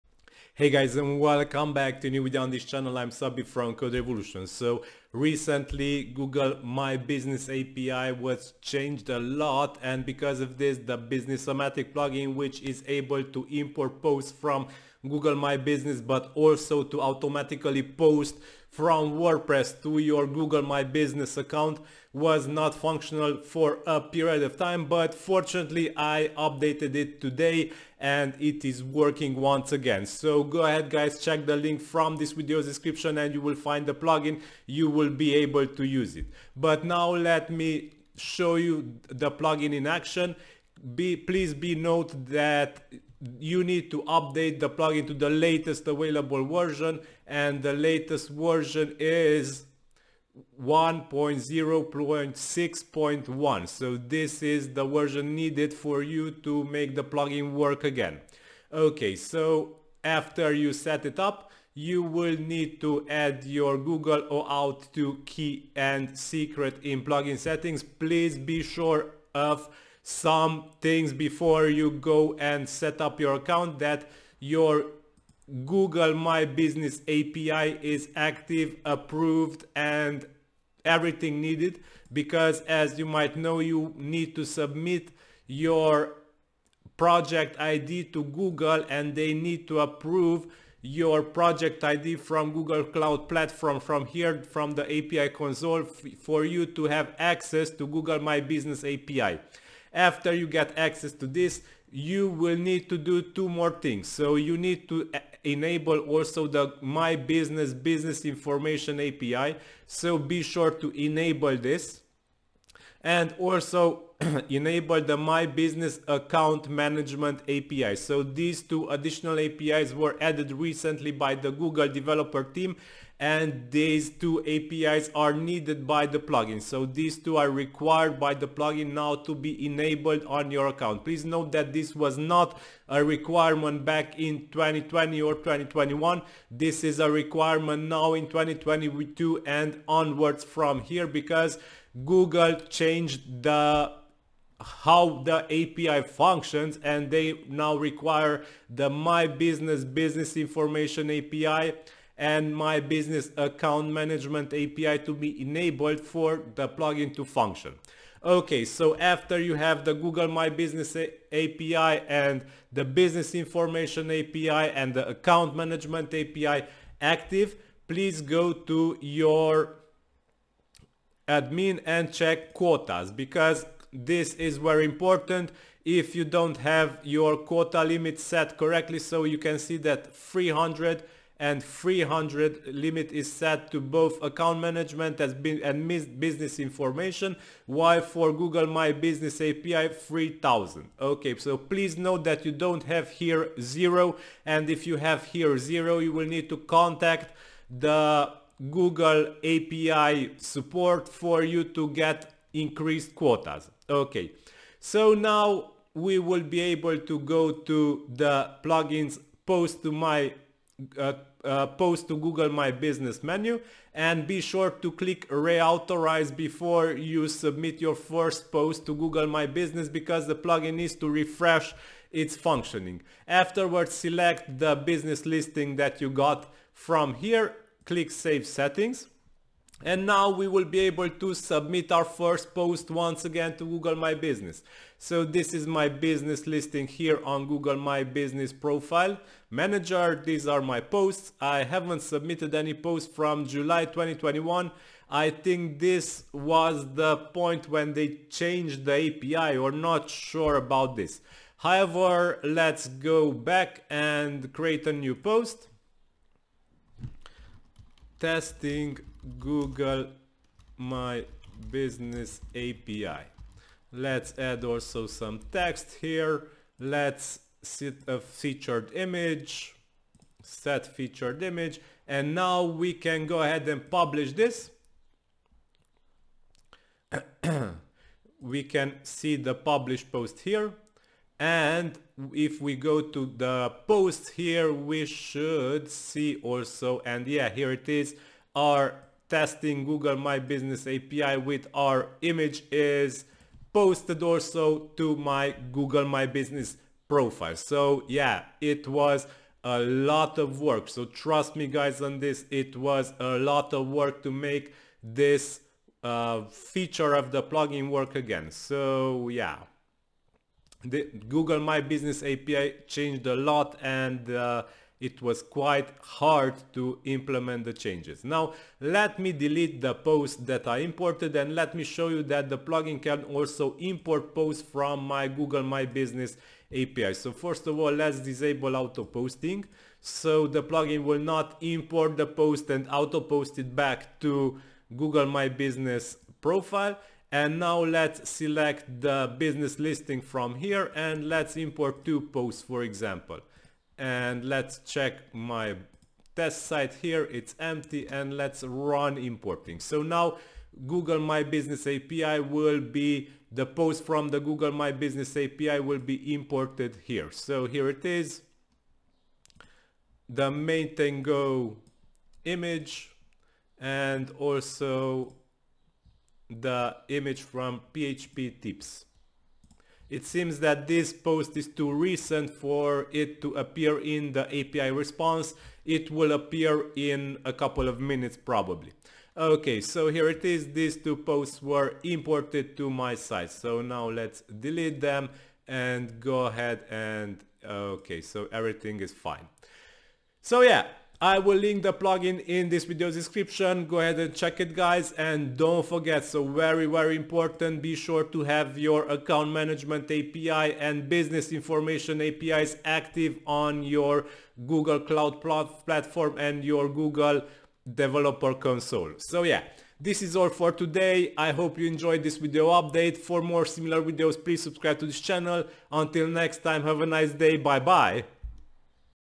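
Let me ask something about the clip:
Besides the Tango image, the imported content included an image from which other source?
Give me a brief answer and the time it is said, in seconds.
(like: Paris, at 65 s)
PHP tips, at 367 s.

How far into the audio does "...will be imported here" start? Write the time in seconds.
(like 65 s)
355 s.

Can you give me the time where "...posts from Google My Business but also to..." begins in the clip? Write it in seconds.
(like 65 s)
14 s.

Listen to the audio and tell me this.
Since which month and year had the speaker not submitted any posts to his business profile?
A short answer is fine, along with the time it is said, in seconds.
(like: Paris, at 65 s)
July 2021, at 243 s.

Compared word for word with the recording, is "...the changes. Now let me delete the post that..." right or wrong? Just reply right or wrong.
right.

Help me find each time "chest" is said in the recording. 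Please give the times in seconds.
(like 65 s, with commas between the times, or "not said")
not said.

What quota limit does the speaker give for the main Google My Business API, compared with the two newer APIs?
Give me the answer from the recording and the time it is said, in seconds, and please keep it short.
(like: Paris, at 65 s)
3000, at 189 s.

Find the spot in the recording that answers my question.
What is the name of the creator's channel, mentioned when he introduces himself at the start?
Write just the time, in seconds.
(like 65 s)
3 s.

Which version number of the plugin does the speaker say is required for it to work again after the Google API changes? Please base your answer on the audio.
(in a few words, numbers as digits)
1.0.6.1.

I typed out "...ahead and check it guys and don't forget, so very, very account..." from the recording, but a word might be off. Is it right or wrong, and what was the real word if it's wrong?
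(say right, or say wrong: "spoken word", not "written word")
wrong: "important", not "account".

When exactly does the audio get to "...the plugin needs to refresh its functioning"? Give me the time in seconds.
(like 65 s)
220 s.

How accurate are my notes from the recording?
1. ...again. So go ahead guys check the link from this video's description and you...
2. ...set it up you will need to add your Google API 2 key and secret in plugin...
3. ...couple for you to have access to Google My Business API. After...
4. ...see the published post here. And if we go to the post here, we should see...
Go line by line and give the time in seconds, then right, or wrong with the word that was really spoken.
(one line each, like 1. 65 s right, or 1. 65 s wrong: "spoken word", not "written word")
1. 29 s right
2. 60 s wrong: "OAuth", not "API"
3. 95 s wrong: "console", not "couple"
4. 279 s right.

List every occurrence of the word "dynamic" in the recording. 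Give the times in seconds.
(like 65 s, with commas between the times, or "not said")
not said.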